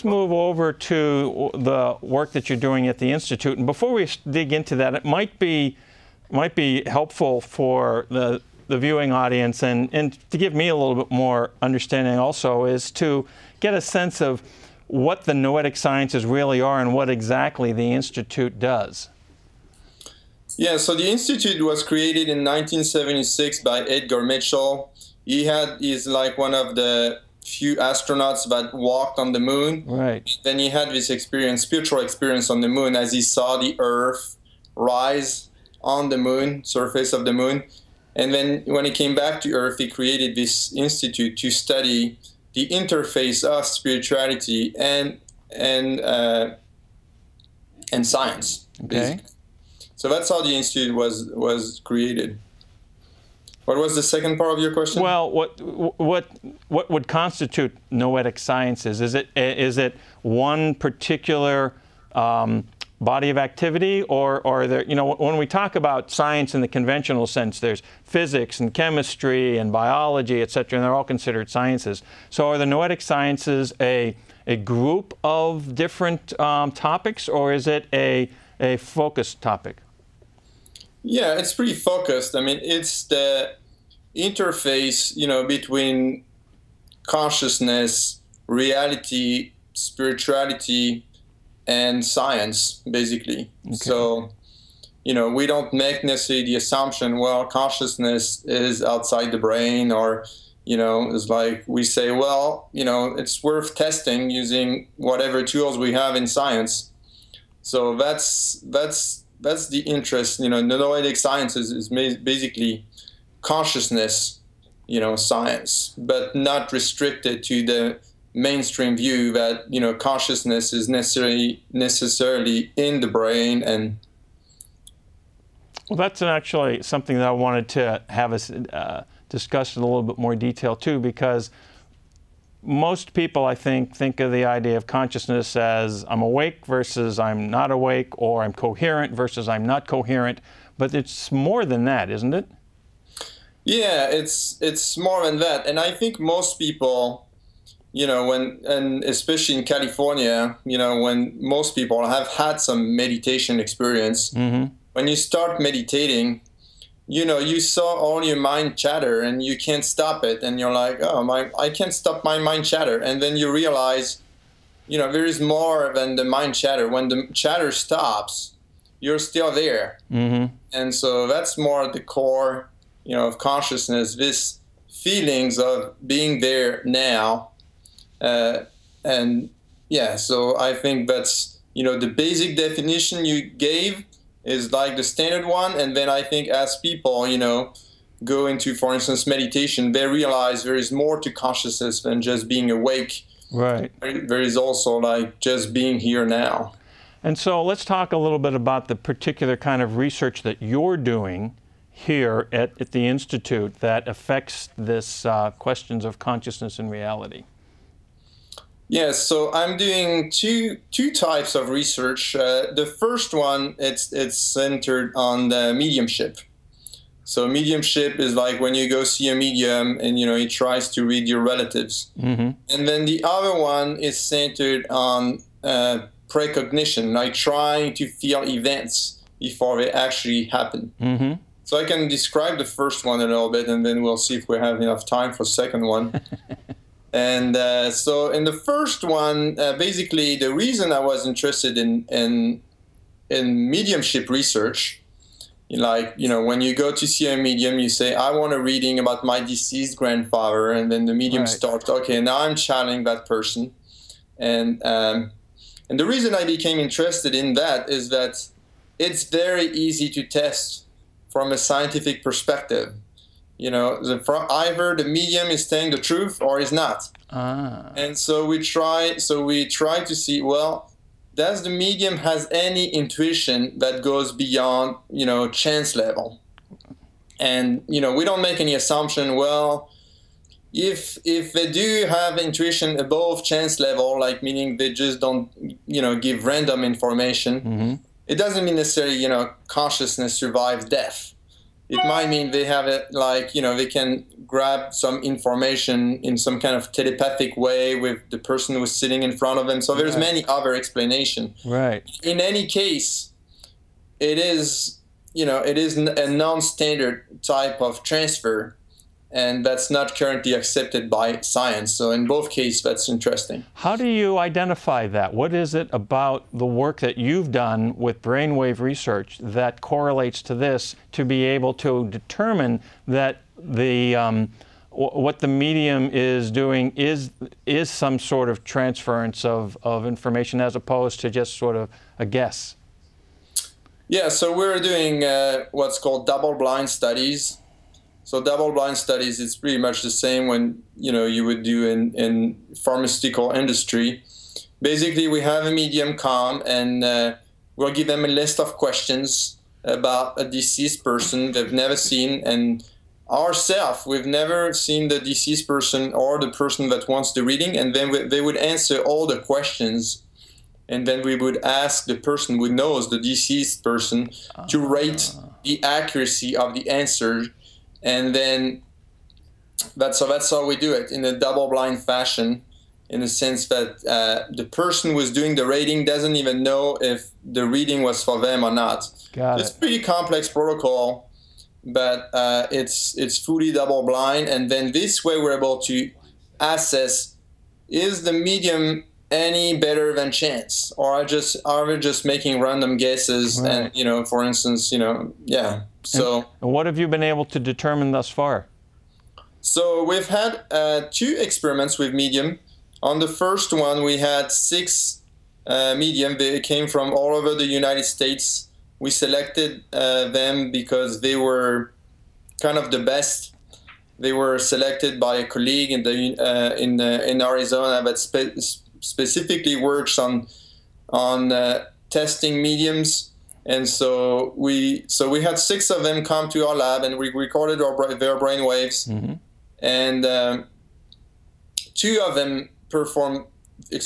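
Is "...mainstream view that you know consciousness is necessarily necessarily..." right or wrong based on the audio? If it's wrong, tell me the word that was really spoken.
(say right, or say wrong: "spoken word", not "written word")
right.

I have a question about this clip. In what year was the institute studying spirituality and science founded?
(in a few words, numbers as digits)
1976.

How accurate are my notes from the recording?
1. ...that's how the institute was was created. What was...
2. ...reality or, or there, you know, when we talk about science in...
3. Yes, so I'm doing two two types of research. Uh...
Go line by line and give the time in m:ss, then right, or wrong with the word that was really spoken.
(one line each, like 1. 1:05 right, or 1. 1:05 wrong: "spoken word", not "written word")
1. 0:50 right
2. 1:03 wrong: "activity", not "reality"
3. 3:28 right.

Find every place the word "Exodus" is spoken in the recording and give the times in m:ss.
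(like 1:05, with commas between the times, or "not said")
not said.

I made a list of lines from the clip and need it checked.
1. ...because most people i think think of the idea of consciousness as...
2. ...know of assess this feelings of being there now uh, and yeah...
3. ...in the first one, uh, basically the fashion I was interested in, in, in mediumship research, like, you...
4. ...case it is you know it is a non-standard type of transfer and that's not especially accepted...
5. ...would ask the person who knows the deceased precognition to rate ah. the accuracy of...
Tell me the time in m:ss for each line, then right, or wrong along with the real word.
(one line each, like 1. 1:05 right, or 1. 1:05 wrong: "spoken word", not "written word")
1. 2:10 right
2. 2:53 wrong: "consciousness", not "assess"
3. 3:58 wrong: "reason", not "fashion"
4. 5:02 wrong: "currently", not "especially"
5. 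6:01 wrong: "person", not "precognition".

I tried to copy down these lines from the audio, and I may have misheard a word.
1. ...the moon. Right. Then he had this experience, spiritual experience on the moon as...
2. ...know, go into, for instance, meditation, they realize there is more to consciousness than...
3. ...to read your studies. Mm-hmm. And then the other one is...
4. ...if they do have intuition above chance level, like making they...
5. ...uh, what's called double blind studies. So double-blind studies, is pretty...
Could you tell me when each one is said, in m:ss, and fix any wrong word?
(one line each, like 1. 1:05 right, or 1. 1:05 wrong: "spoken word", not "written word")
1. 0:29 right
2. 3:07 right
3. 3:40 wrong: "relatives", not "studies"
4. 4:41 wrong: "meaning", not "making"
5. 5:35 right.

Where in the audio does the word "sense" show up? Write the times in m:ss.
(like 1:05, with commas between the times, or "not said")
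0:13, 1:07, 6:13.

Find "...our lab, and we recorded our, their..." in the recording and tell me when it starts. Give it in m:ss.
7:06.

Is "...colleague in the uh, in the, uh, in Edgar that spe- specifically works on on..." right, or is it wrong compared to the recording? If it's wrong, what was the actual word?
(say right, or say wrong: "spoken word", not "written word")
wrong: "Arizona", not "Edgar".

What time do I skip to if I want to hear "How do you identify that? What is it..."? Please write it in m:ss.
5:13.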